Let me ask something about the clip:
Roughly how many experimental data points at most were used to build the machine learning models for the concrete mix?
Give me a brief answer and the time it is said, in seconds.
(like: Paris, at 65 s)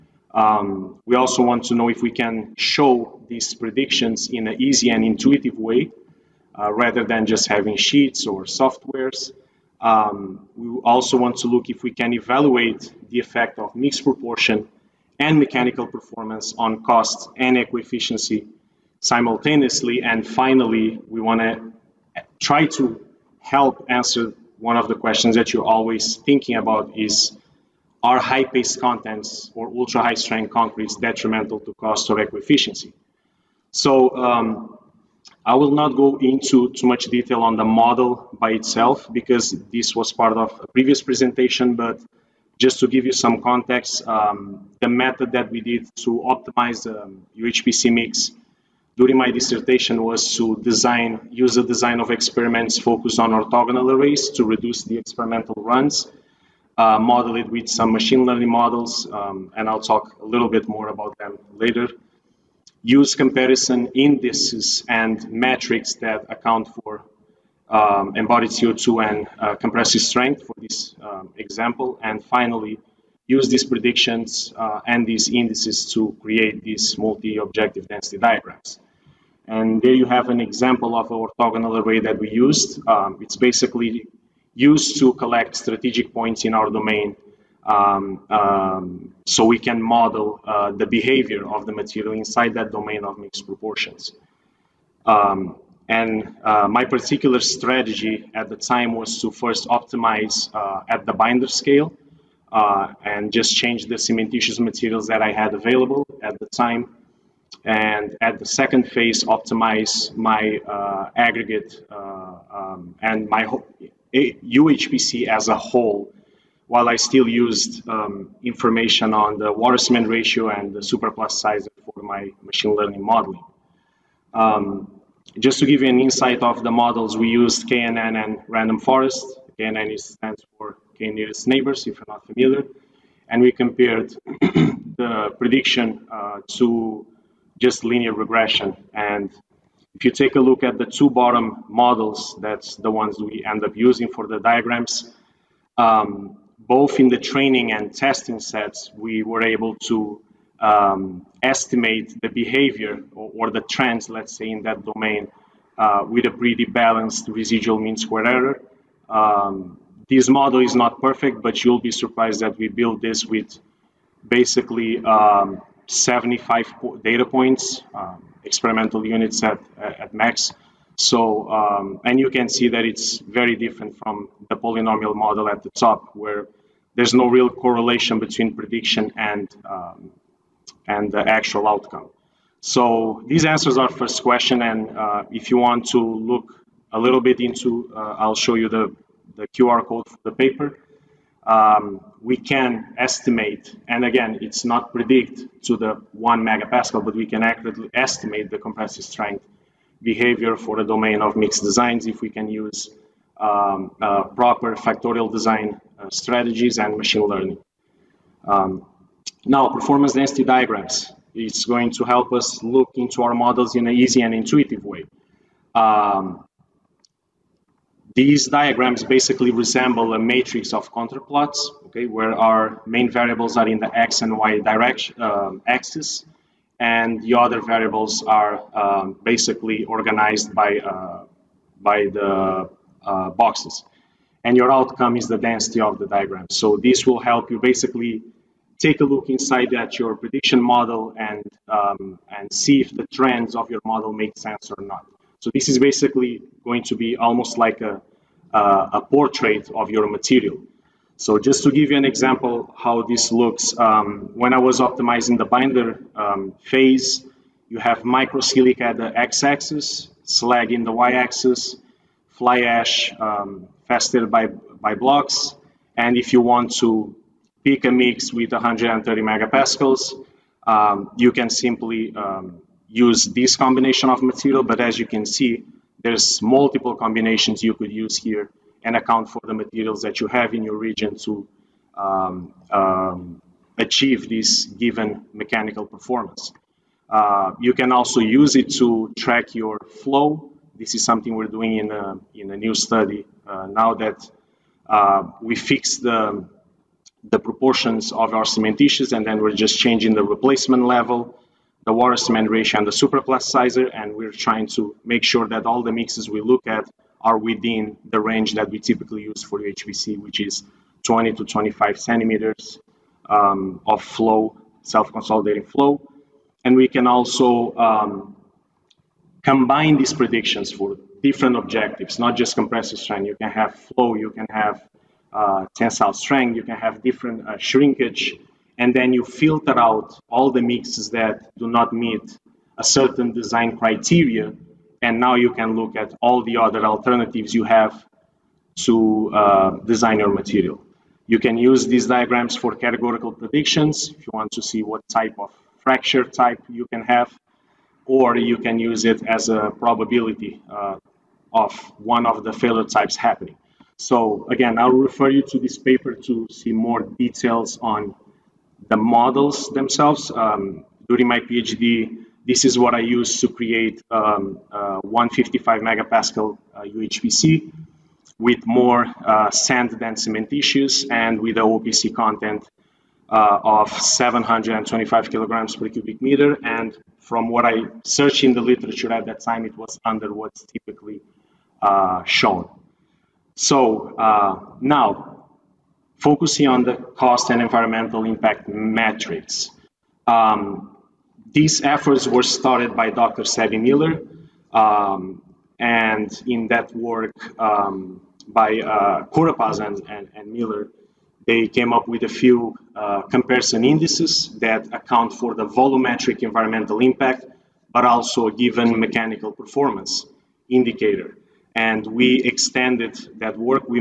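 75, at 165 s.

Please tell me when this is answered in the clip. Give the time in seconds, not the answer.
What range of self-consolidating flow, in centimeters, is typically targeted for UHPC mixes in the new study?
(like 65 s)
311 s.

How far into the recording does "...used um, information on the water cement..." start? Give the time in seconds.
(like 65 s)
117 s.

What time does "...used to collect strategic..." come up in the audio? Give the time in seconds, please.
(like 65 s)
84 s.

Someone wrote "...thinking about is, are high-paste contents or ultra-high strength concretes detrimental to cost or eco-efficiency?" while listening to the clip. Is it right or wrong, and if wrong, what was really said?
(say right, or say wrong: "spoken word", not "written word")
right.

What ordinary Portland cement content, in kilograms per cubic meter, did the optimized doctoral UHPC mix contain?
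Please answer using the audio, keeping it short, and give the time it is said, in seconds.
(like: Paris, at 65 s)
725, at 373 s.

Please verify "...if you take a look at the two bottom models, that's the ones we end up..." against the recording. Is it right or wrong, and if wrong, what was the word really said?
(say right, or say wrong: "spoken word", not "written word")
right.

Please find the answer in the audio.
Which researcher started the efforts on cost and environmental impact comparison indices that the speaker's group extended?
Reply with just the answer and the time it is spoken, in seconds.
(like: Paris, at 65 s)
Sabbie Miller, at 393 s.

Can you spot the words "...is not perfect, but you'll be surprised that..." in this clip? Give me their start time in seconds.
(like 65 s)
160 s.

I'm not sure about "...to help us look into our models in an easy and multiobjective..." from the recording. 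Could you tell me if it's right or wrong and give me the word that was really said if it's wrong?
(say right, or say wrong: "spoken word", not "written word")
wrong: "intuitive", not "multiobjective".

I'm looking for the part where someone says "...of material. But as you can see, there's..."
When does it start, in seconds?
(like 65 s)
274 s.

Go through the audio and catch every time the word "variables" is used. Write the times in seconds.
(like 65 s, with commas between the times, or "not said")
223 s, 227 s.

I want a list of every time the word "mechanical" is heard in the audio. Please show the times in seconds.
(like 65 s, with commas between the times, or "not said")
15 s, 285 s, 408 s.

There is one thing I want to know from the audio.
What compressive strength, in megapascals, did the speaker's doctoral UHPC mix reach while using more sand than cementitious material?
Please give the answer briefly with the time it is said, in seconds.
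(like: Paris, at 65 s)
155 megapascals, at 365 s.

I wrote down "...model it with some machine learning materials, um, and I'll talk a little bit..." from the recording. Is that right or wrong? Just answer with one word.
wrong.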